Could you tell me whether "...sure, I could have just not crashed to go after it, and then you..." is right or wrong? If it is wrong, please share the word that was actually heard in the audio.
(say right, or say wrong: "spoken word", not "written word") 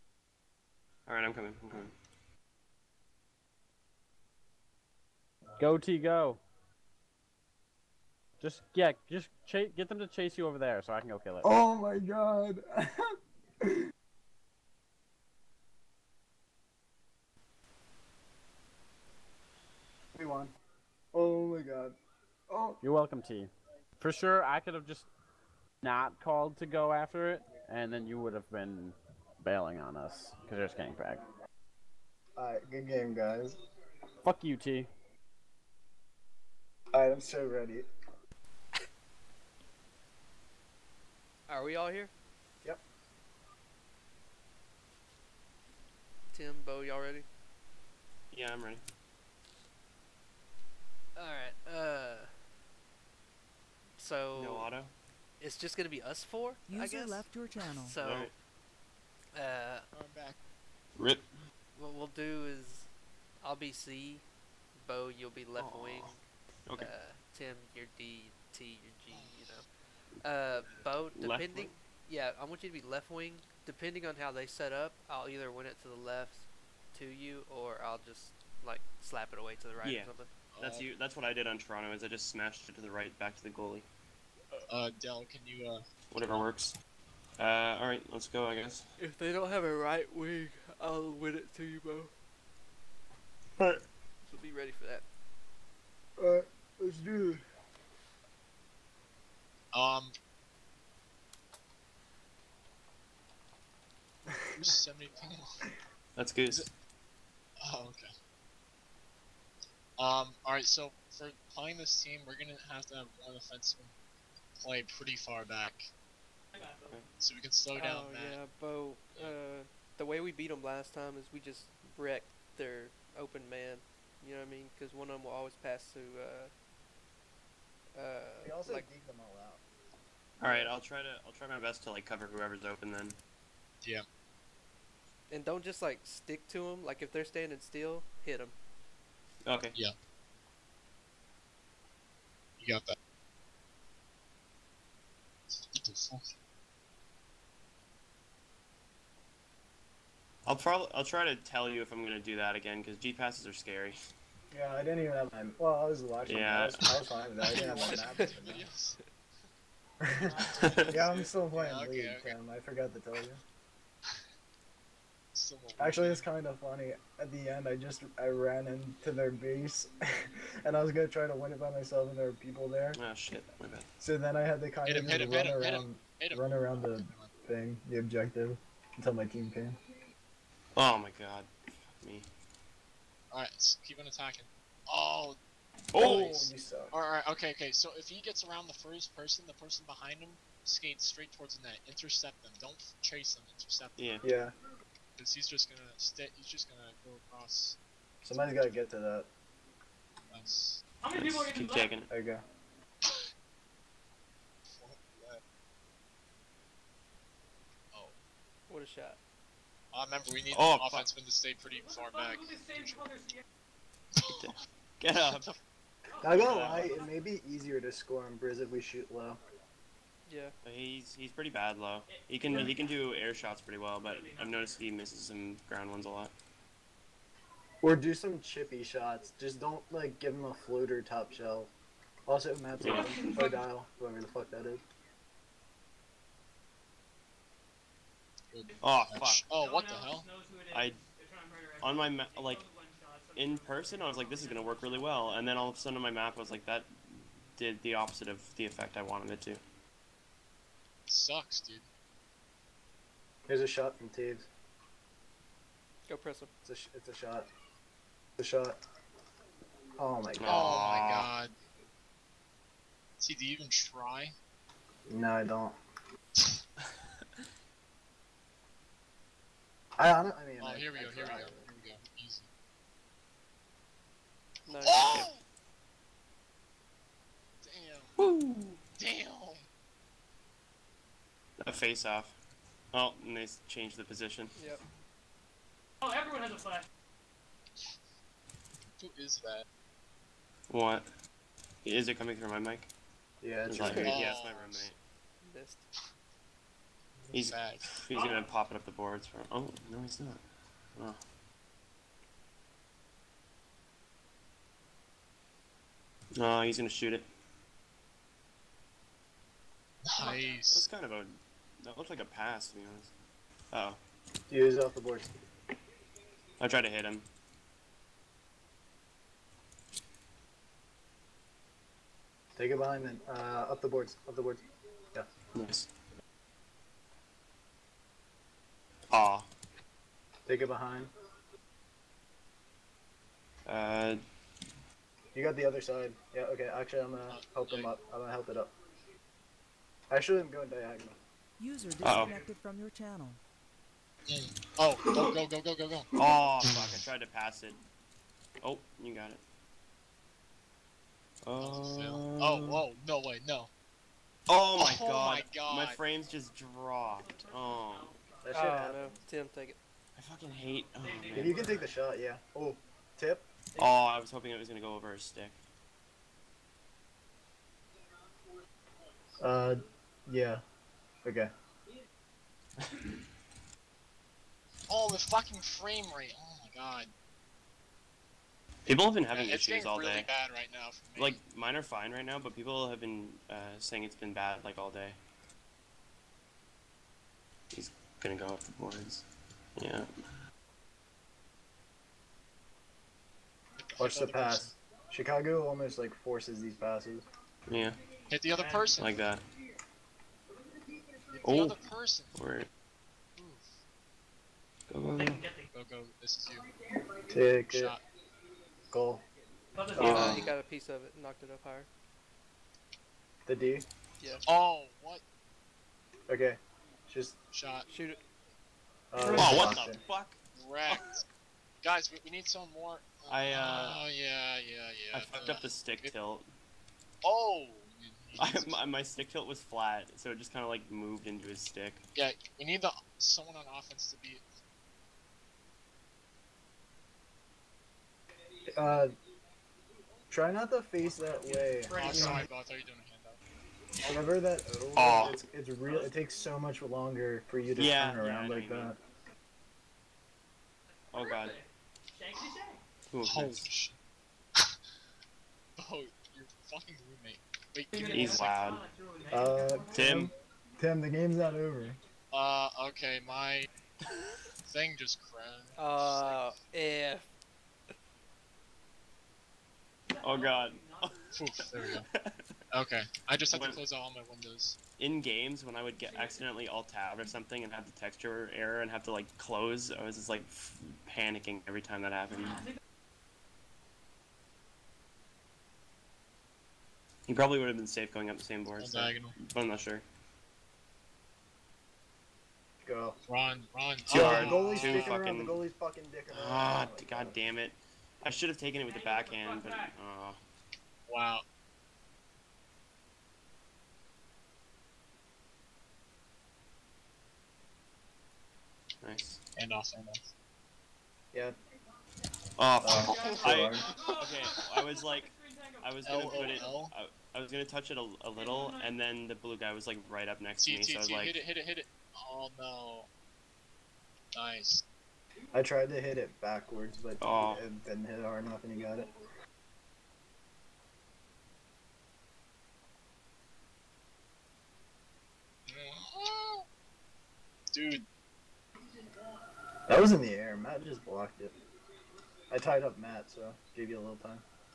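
wrong: "called", not "crashed".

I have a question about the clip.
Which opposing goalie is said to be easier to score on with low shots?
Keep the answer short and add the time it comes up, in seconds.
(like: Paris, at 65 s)
Briz, at 218 s.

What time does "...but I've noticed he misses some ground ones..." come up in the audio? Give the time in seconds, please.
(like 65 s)
224 s.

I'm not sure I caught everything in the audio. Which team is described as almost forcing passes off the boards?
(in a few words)
Chicago.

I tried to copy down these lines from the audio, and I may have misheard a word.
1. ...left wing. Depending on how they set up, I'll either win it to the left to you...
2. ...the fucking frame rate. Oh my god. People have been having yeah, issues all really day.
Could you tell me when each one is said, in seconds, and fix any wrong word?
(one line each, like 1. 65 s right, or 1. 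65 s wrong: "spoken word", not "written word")
1. 72 s right
2. 375 s right.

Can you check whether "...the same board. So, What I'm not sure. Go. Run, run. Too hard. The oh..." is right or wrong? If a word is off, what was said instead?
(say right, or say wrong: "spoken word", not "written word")
wrong: "But", not "What".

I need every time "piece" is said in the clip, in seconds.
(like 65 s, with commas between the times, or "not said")
410 s.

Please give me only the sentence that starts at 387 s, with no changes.
These gonna go off the boards.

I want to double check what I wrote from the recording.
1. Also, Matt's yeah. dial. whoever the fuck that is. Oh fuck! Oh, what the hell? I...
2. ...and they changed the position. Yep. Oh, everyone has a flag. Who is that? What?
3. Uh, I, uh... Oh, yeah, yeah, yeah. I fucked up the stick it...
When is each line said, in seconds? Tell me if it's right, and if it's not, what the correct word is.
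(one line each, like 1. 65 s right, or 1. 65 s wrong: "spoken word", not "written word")
1. 232 s right
2. 283 s right
3. 423 s right.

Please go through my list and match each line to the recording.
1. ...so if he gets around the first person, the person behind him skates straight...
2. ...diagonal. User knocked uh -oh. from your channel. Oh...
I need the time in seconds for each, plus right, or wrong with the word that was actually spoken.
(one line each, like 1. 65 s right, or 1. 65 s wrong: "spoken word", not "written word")
1. 187 s right
2. 340 s wrong: "disconnected", not "knocked".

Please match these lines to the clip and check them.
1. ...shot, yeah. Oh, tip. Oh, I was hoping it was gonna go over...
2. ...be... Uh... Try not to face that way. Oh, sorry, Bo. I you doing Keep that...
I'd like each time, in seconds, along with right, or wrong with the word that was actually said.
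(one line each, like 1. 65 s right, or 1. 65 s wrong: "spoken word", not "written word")
1. 361 s right
2. 434 s wrong: "Whenever", not "Keep".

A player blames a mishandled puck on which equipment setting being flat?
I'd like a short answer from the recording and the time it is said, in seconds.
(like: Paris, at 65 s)
stick tilt, at 429 s.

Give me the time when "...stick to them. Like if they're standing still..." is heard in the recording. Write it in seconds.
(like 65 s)
136 s.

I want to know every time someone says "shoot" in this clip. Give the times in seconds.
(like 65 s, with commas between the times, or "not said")
218 s, 306 s, 417 s.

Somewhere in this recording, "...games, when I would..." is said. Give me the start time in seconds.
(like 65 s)
475 s.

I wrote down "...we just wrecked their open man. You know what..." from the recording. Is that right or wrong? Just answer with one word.
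right.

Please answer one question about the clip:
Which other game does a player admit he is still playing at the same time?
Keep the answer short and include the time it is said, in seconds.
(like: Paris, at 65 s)
League, at 161 s.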